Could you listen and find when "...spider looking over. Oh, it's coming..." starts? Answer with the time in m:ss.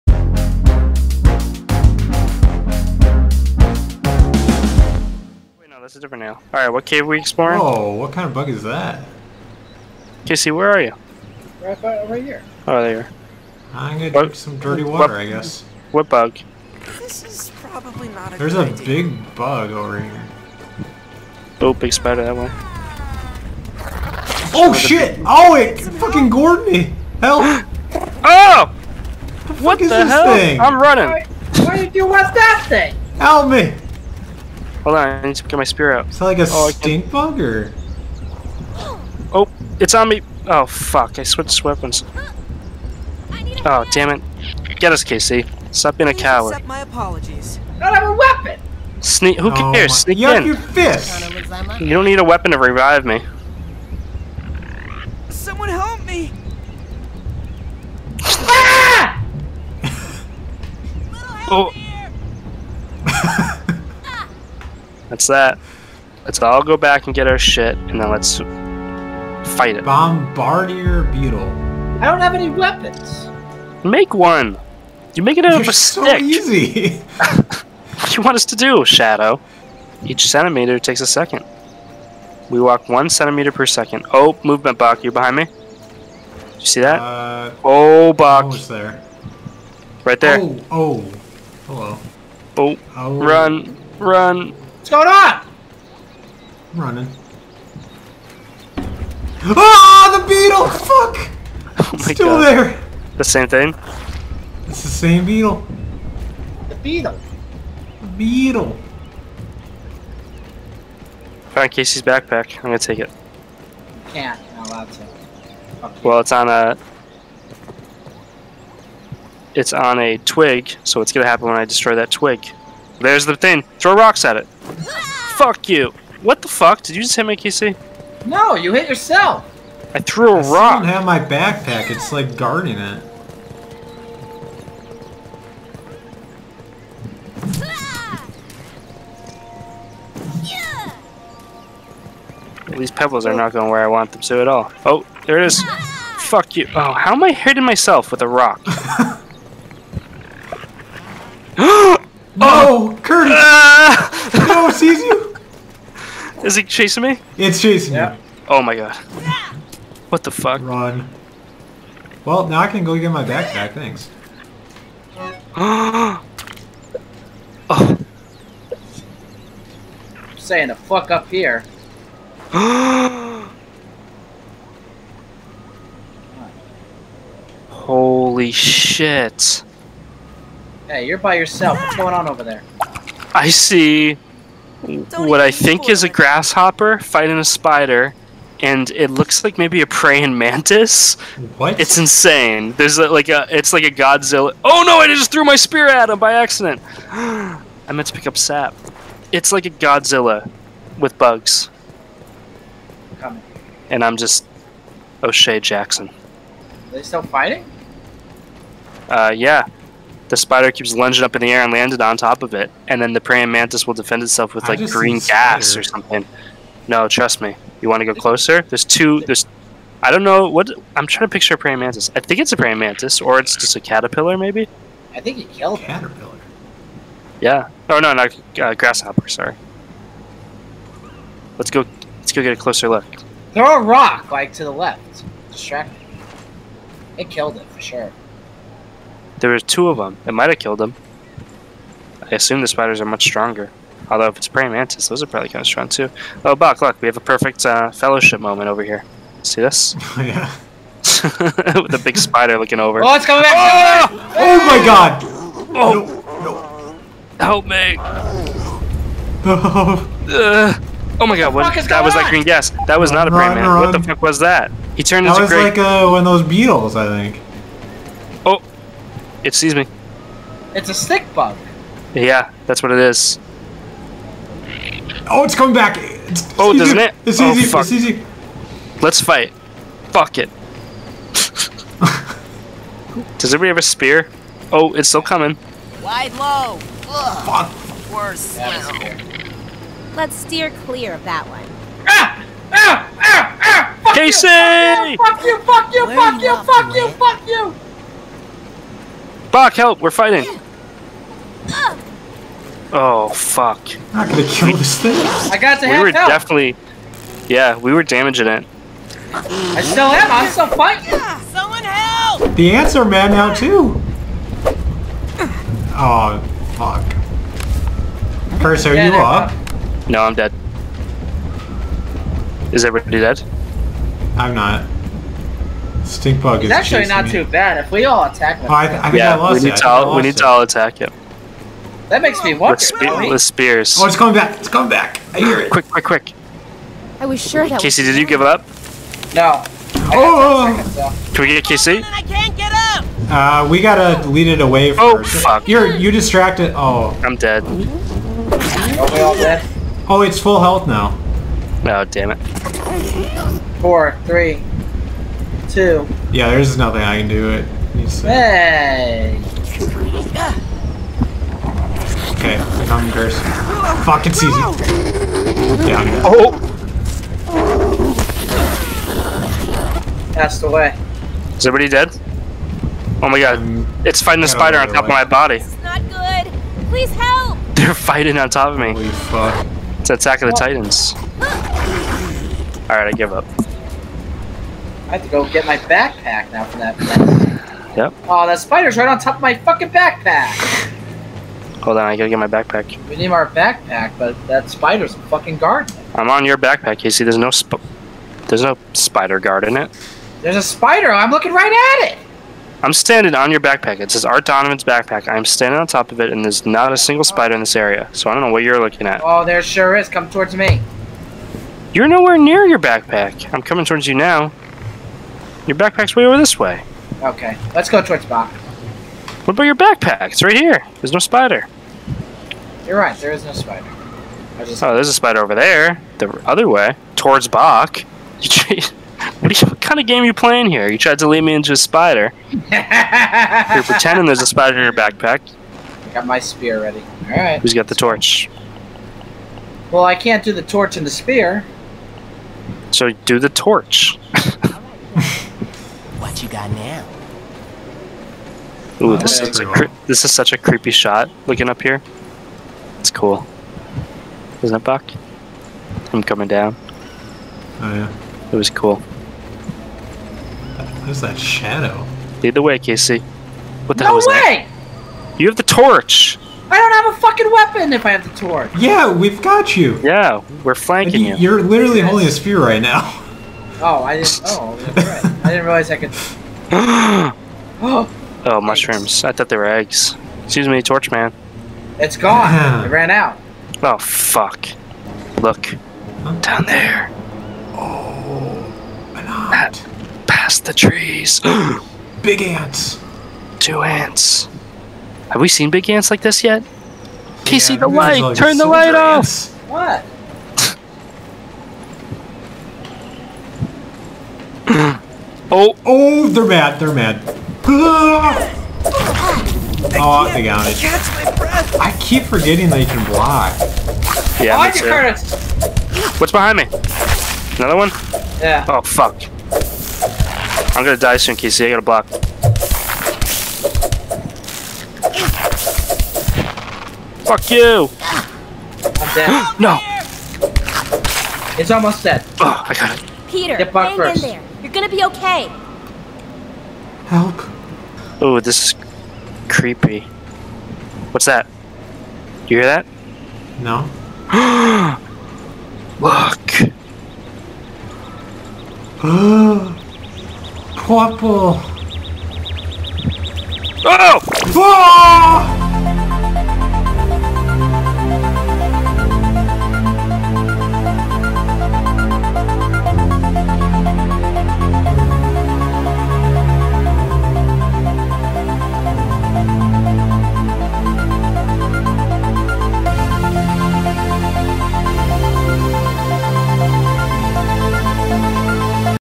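4:12.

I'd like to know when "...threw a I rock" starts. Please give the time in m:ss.
2:09.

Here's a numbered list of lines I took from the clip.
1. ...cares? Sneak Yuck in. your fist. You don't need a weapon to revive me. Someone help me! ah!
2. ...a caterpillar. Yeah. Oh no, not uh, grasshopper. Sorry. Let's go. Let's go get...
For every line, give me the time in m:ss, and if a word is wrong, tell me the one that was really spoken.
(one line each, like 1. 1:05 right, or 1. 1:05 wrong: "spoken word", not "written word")
1. 0:49 right
2. 3:45 right.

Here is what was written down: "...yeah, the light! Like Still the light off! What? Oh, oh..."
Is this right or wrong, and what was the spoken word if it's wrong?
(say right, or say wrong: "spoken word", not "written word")
wrong: "Turn", not "Still".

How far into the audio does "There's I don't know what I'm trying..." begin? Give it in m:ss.
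3:39.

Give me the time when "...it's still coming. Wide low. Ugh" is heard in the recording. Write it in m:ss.
4:44.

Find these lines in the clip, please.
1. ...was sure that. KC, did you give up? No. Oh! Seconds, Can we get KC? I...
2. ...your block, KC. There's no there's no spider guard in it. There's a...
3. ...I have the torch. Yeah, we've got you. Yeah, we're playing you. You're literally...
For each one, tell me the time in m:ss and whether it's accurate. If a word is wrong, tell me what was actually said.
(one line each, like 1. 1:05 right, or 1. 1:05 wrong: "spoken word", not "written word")
1. 5:37 right
2. 6:36 wrong: "backpack", not "block"
3. 7:48 wrong: "flanking", not "playing".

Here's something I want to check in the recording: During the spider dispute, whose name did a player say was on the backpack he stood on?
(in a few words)
Art Donovan.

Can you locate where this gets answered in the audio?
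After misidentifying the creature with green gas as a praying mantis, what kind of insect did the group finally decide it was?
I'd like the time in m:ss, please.
4:30.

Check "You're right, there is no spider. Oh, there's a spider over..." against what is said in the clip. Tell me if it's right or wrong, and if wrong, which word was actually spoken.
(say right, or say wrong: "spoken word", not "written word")
right.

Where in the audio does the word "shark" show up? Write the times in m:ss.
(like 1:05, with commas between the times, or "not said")
not said.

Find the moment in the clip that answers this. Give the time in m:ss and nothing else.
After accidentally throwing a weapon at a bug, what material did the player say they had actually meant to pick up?
3:18.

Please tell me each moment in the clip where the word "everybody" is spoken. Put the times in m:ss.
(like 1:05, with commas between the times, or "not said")
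4:43, 5:22, 6:11.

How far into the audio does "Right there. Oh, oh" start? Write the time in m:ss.
1:30.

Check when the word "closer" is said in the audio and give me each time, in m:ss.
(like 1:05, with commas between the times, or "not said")
3:38, 3:52.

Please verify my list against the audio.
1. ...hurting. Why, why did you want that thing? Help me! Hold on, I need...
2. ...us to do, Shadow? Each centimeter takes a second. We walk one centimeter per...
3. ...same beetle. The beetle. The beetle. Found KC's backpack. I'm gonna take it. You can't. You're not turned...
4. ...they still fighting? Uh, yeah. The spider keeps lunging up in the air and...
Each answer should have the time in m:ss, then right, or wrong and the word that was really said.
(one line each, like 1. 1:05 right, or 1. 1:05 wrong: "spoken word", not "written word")
1. 0:30 wrong: "running", not "hurting"
2. 1:18 right
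3. 1:44 wrong: "allowed", not "turned"
4. 3:26 right.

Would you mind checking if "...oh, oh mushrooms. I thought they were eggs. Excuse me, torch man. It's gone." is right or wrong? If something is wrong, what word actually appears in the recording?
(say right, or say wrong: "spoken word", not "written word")
right.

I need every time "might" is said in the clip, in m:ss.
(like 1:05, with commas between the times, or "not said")
4:00.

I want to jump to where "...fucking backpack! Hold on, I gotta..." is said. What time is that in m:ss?
6:29.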